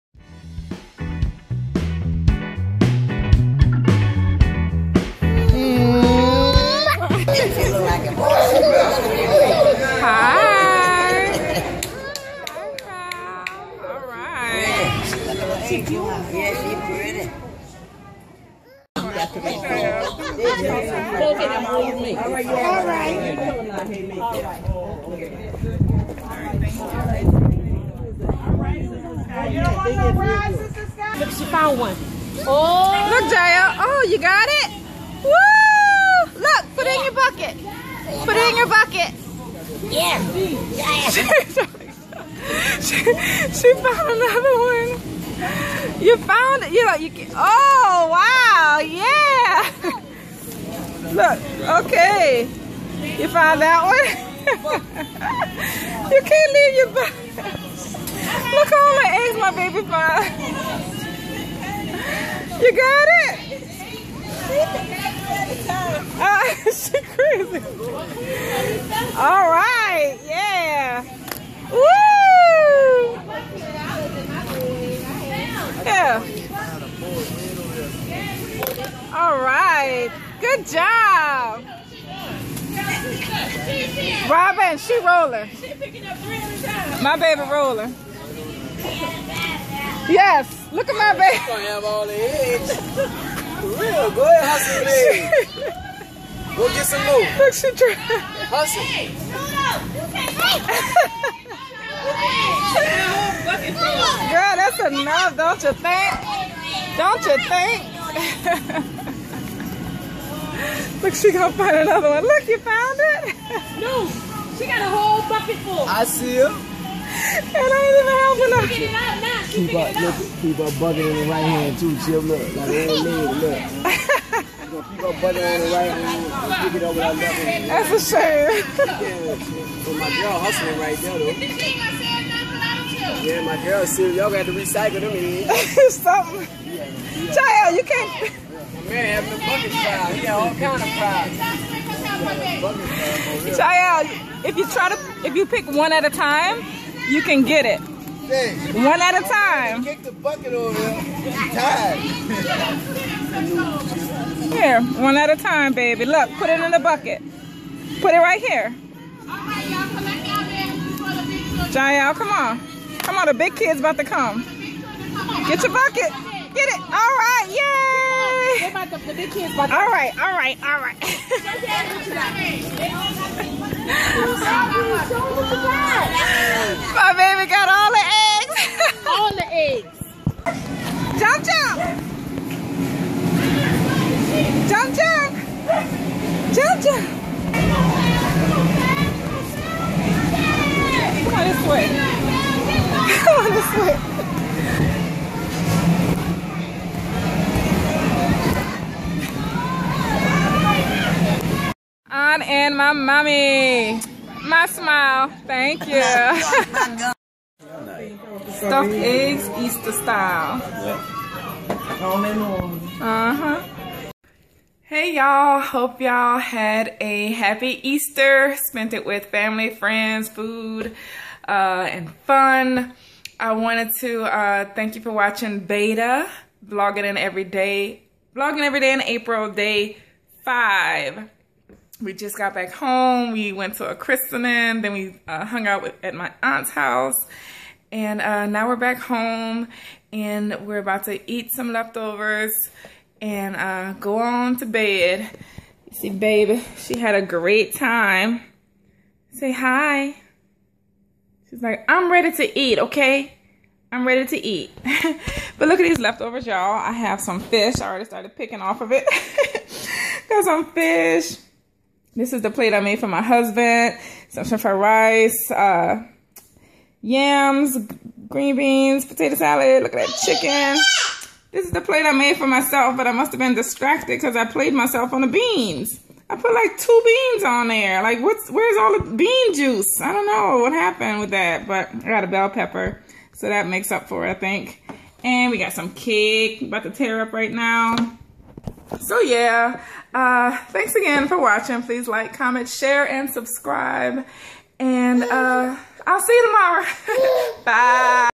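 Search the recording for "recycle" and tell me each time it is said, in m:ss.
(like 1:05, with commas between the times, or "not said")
2:14.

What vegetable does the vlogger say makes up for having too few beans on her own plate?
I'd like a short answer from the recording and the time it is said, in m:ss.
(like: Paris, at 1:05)
Bell pepper, at 4:42.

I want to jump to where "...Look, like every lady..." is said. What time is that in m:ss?
2:02.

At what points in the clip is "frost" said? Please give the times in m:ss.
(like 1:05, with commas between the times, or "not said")
not said.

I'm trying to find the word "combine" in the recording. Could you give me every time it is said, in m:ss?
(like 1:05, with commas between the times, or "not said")
not said.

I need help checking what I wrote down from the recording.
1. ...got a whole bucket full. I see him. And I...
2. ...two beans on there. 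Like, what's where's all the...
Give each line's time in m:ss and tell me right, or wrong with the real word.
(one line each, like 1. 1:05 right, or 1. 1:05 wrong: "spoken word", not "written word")
1. 1:54 right
2. 4:36 right.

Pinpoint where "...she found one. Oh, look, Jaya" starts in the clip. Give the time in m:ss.
0:31.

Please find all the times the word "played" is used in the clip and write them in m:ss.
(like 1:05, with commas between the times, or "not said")
4:34.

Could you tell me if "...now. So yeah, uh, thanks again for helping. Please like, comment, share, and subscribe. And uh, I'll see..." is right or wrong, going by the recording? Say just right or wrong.
wrong.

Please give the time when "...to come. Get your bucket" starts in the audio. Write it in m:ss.
2:43.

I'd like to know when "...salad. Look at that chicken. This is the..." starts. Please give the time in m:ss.
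4:29.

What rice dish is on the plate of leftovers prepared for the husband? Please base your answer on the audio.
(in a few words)
Shrimp fried rice.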